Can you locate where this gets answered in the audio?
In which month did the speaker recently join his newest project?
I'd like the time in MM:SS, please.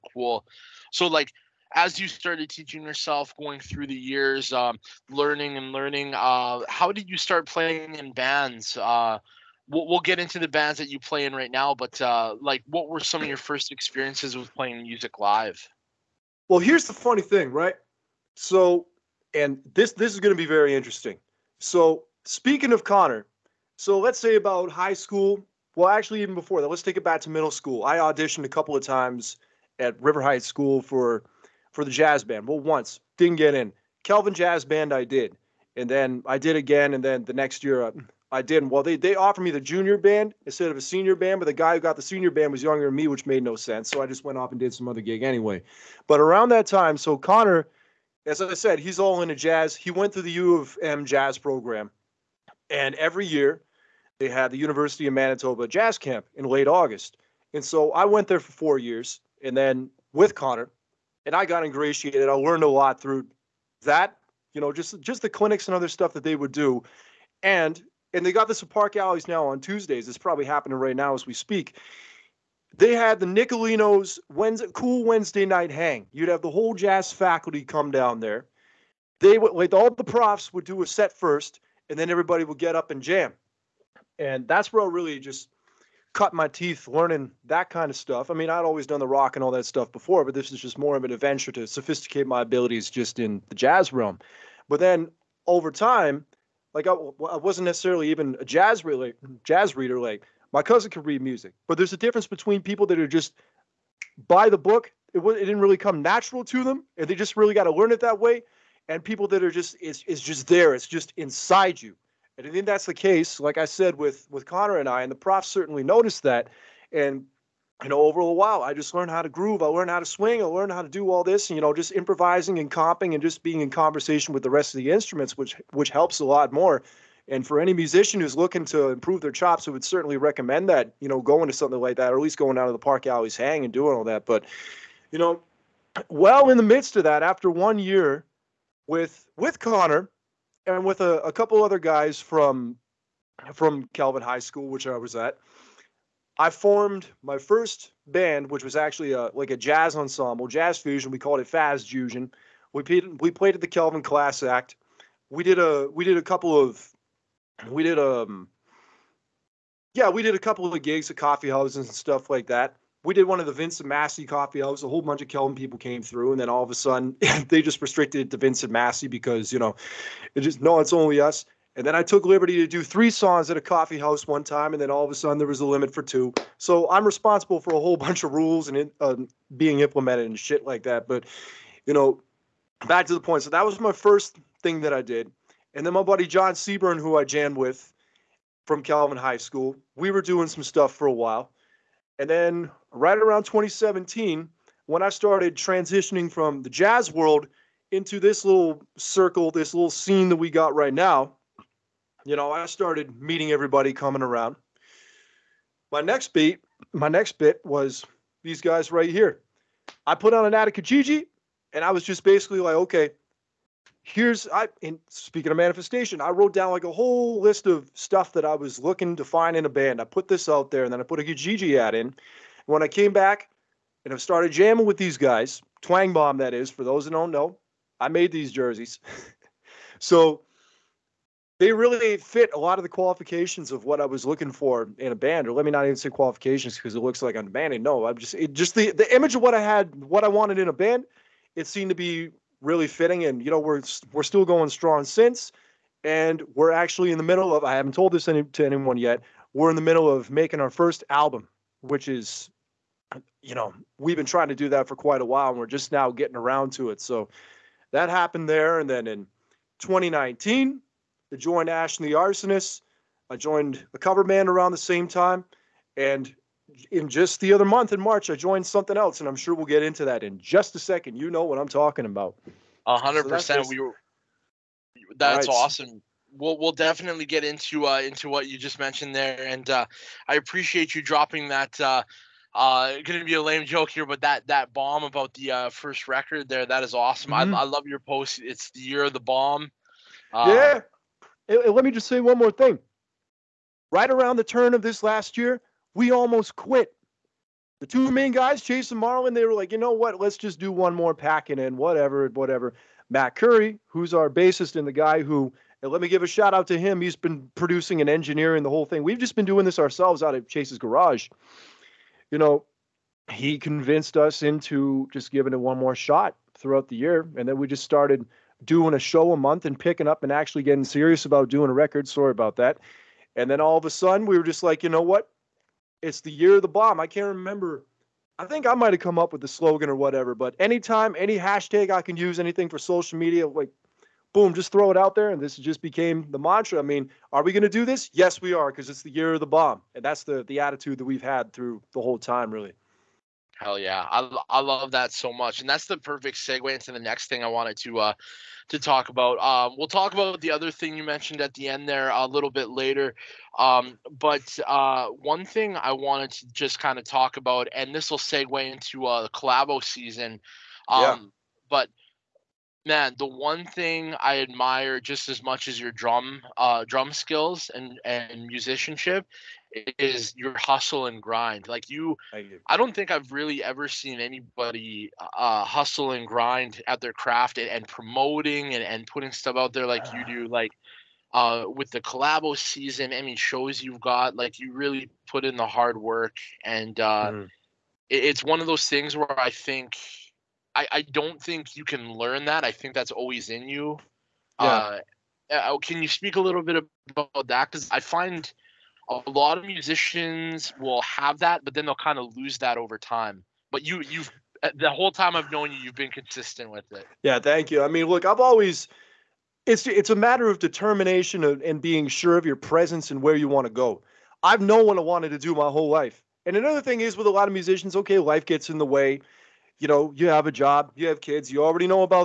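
04:27.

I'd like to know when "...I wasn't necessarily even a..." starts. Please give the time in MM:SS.
01:36.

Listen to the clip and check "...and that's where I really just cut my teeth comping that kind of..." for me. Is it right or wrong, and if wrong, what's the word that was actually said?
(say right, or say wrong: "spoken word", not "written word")
wrong: "learning", not "comping".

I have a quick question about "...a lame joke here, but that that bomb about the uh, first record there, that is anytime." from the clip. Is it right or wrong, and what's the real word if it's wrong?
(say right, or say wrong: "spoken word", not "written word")
wrong: "awesome", not "anytime".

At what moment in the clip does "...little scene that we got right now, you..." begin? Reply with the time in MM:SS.
03:19.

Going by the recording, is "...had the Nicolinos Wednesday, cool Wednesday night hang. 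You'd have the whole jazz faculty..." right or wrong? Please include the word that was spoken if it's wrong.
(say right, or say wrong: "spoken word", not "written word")
right.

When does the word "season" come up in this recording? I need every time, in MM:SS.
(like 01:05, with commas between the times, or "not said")
05:59, 06:22.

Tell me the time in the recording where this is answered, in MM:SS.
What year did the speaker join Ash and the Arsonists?
04:19.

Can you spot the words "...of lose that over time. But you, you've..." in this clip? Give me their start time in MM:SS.
06:42.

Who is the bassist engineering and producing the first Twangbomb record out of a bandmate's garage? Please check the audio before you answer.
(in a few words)
Matt Curry.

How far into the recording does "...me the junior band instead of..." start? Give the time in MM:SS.
00:39.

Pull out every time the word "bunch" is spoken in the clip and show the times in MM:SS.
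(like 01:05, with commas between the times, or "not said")
02:45, 02:57.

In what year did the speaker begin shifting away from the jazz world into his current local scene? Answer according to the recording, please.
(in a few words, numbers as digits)
2017.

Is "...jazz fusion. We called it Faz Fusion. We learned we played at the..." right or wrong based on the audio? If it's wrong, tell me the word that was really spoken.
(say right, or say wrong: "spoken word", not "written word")
wrong: "played", not "learned".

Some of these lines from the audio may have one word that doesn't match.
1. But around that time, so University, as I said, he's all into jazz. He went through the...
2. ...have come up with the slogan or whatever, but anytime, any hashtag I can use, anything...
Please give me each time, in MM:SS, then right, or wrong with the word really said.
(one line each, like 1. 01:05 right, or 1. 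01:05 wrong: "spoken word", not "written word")
1. 00:46 wrong: "Connor", not "University"
2. 05:28 right.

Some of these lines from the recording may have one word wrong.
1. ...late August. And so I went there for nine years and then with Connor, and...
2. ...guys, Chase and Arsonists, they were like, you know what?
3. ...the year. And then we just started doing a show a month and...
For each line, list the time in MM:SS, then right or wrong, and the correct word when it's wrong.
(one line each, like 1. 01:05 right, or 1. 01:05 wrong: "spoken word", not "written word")
1. 00:56 wrong: "four", not "nine"
2. 04:58 wrong: "Marlin", not "Arsonists"
3. 05:16 right.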